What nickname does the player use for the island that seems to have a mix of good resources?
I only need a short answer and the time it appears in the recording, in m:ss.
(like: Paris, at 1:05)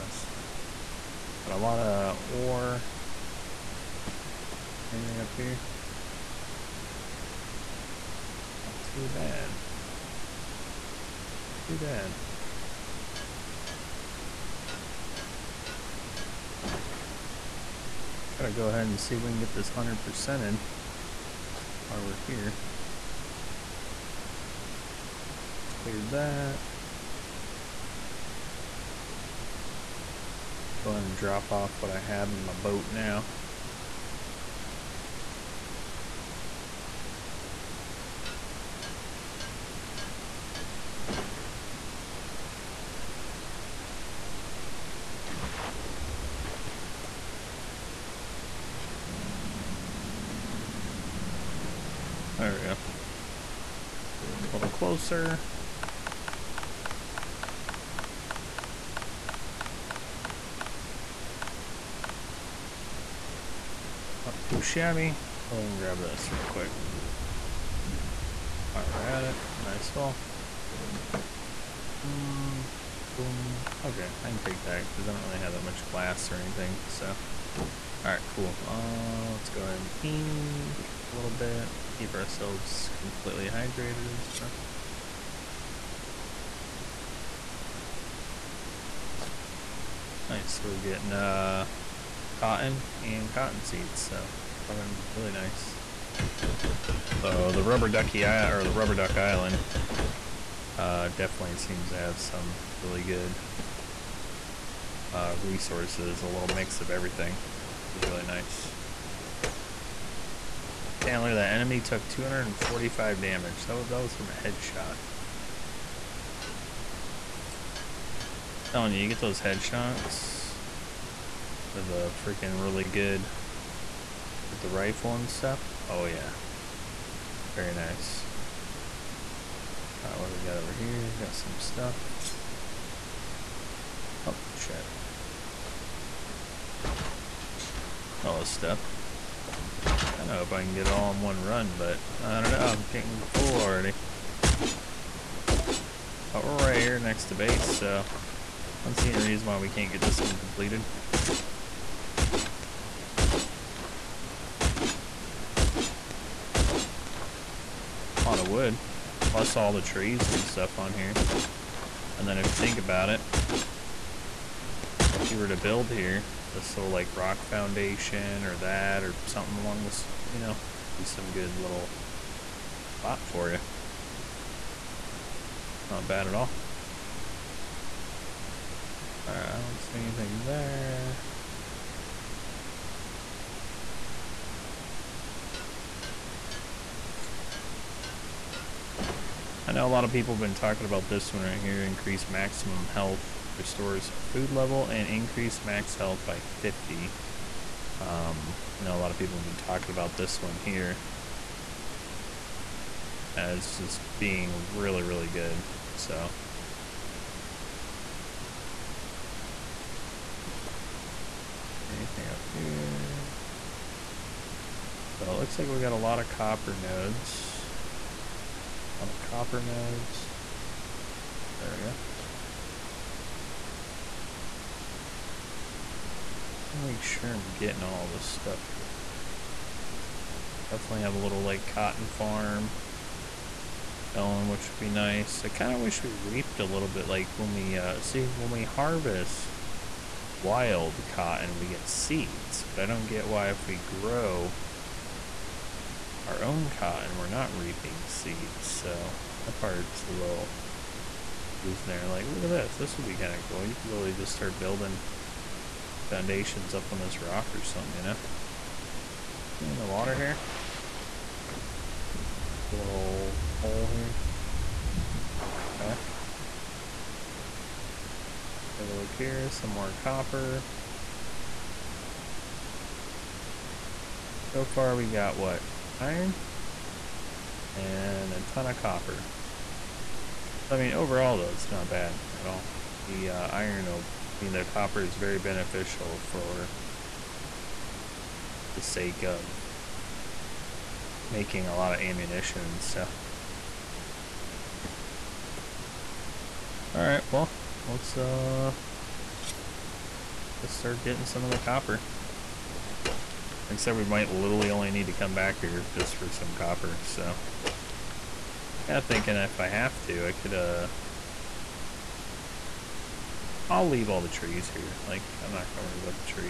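rubber duck island, at 1:38.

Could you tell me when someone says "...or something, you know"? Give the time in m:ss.
4:17.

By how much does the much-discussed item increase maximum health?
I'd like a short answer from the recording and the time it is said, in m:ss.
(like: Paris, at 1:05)
50, at 3:16.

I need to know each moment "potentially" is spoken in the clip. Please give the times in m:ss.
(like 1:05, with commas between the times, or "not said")
not said.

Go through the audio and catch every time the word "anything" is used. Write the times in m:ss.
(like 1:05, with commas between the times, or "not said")
0:04, 1:16, 2:59, 3:31.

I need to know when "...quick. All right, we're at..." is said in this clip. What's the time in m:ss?
1:06.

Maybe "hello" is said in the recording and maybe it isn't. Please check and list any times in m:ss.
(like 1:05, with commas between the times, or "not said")
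not said.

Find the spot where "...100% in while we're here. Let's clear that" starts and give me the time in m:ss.
0:19.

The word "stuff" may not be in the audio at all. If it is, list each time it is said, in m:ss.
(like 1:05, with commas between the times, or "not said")
1:24, 2:05, 2:11, 2:18, 2:40, 3:48, 4:52.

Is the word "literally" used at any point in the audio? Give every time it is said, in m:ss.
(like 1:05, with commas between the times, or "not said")
4:13, 5:04.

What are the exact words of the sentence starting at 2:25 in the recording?
But we're right here next to base, so I don't see any reason why we can't get this one completed.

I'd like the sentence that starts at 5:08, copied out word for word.
Kinda thinking if I have to, I could, uh...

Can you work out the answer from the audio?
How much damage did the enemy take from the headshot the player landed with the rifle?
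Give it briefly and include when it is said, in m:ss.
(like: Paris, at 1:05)
245, at 1:52.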